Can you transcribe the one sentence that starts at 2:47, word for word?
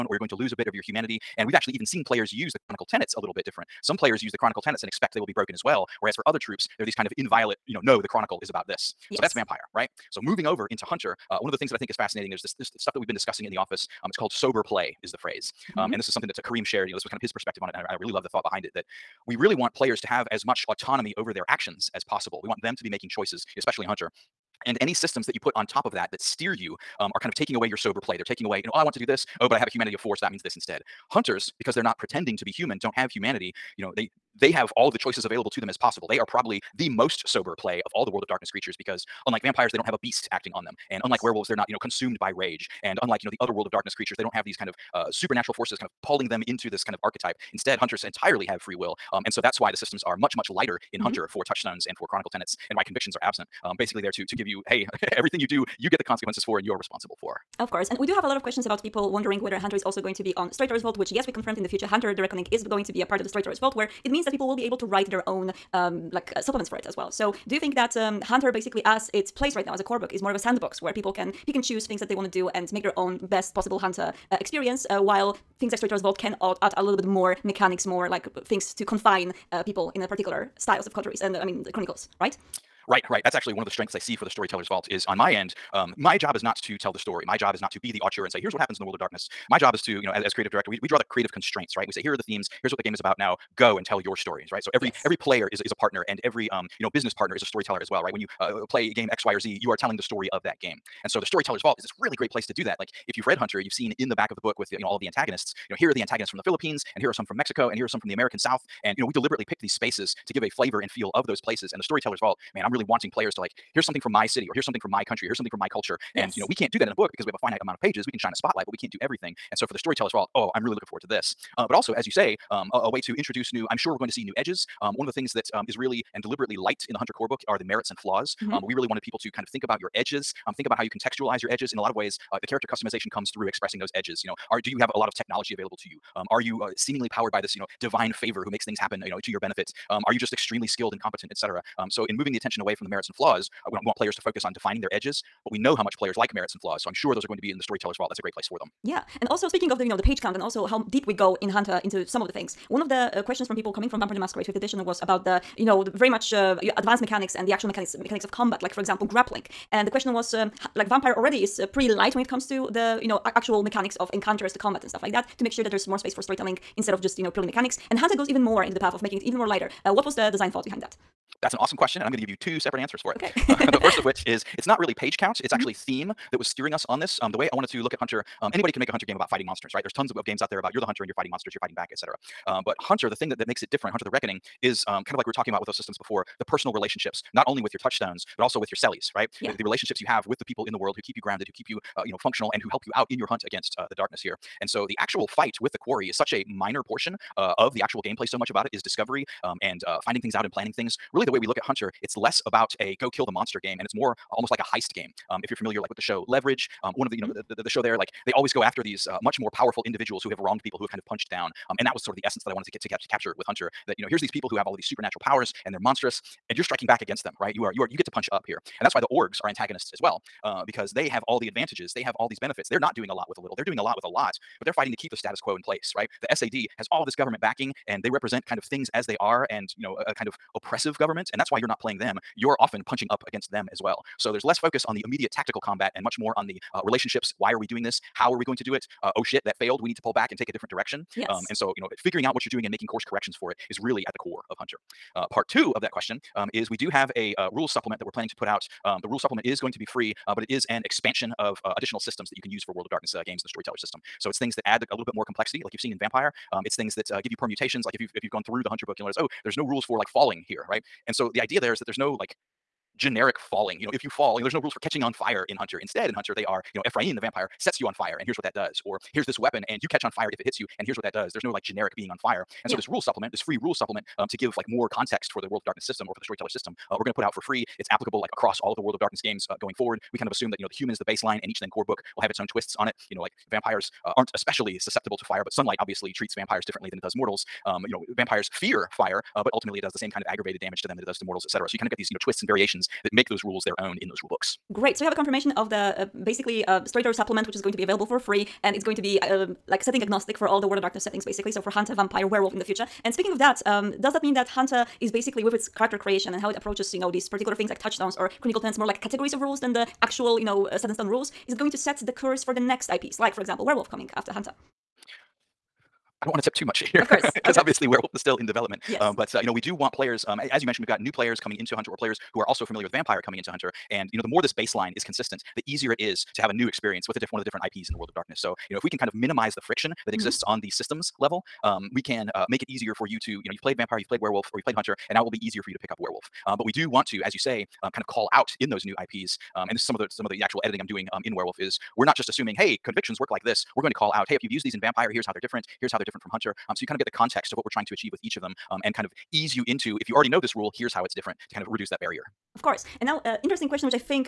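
And Hunter goes even more into the path of making it even more lighter.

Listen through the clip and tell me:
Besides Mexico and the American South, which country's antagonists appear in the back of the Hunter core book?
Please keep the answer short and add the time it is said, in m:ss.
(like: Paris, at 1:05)
The Philippines, at 1:46.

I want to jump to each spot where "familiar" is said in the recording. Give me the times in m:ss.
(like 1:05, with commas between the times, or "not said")
3:25, 5:22.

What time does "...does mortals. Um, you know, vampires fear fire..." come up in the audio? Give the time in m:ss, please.
4:47.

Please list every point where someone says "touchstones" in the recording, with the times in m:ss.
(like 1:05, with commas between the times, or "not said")
0:51, 3:07, 5:07.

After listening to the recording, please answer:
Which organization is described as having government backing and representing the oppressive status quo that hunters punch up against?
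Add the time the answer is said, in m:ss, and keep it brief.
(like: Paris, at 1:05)
The SAD, at 3:46.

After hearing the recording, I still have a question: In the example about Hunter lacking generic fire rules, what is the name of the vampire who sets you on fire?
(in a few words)
Ephraim.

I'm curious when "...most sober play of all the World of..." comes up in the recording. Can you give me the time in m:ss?
0:36.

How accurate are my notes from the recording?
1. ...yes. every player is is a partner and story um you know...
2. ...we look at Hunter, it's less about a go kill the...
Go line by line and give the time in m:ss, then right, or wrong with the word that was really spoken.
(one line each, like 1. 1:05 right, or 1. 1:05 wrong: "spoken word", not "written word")
1. 1:34 wrong: "every", not "story"
2. 3:21 right.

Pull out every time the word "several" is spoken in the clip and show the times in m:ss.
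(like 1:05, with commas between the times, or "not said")
not said.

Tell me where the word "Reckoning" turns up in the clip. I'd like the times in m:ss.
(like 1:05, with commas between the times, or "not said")
1:02, 3:04.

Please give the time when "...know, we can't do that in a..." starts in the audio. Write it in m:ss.
1:56.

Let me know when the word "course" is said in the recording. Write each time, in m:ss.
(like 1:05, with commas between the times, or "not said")
0:57, 4:02, 5:12, 5:17, 5:52.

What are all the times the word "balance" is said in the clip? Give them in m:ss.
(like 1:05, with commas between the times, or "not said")
not said.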